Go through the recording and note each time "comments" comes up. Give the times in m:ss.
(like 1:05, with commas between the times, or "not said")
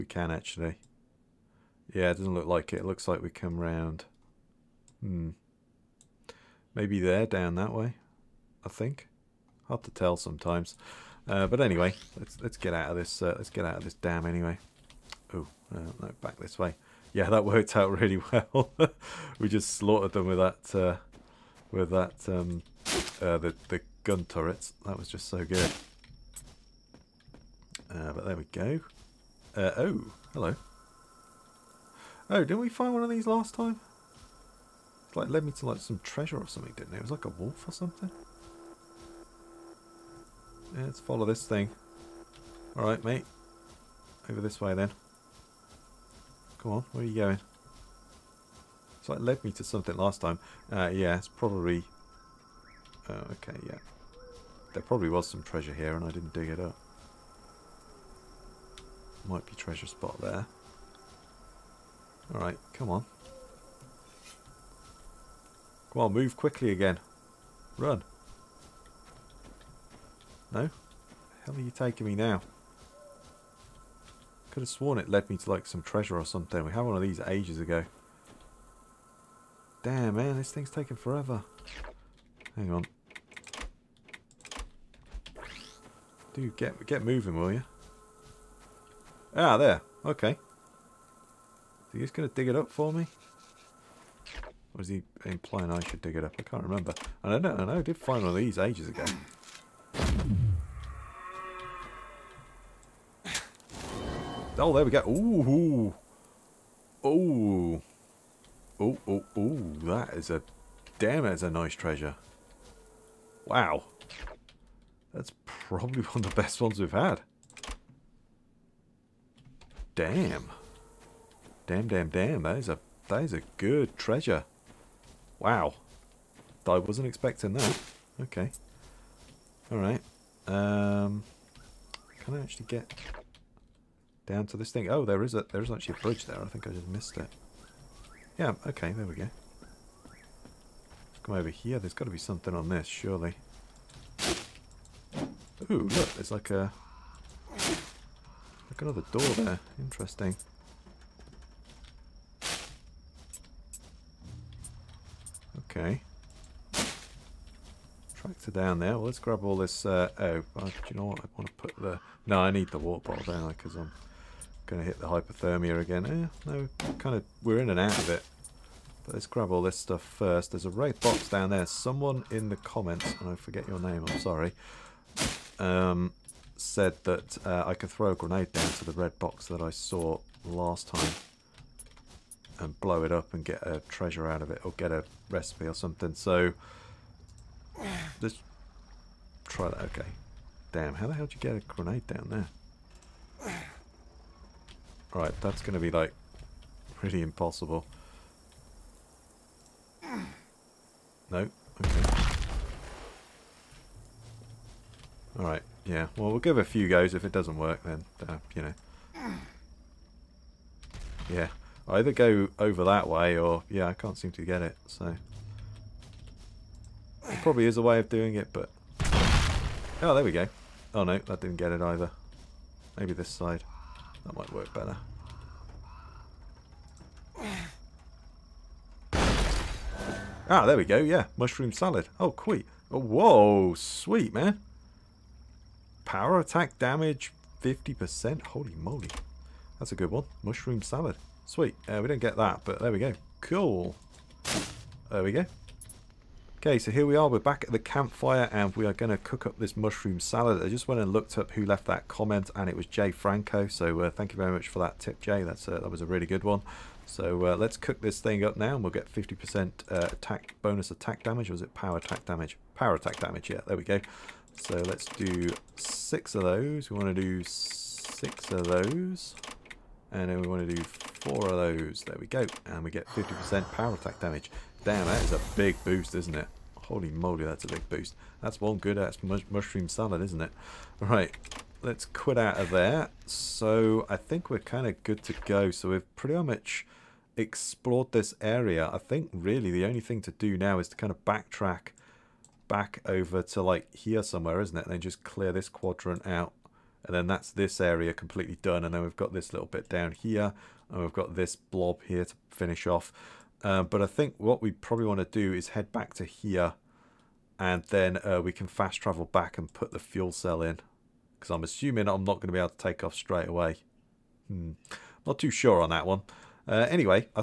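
2:52, 4:12.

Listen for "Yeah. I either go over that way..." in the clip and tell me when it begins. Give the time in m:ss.
3:31.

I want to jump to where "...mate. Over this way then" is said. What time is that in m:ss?
0:43.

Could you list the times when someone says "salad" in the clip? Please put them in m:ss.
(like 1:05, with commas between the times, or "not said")
3:51, 4:00, 4:10, 4:39.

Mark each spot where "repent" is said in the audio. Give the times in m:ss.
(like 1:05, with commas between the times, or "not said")
not said.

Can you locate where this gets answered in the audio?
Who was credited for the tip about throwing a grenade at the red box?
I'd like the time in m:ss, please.
4:12.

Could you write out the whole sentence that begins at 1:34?
Or is he implying I should dig it up?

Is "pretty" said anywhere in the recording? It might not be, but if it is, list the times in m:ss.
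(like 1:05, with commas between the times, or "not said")
3:16, 4:46.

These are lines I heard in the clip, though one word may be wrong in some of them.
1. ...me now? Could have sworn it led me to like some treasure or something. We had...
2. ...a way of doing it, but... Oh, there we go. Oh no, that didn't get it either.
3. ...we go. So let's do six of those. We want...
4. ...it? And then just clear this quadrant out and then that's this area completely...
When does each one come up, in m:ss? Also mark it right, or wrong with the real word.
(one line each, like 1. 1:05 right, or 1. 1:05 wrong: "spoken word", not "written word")
1. 1:12 right
2. 3:37 right
3. 4:23 right
4. 4:54 right.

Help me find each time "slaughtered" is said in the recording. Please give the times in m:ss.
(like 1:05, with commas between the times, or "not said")
0:19.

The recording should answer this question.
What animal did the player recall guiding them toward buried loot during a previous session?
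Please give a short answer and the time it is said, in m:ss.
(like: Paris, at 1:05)
wolf, at 0:37.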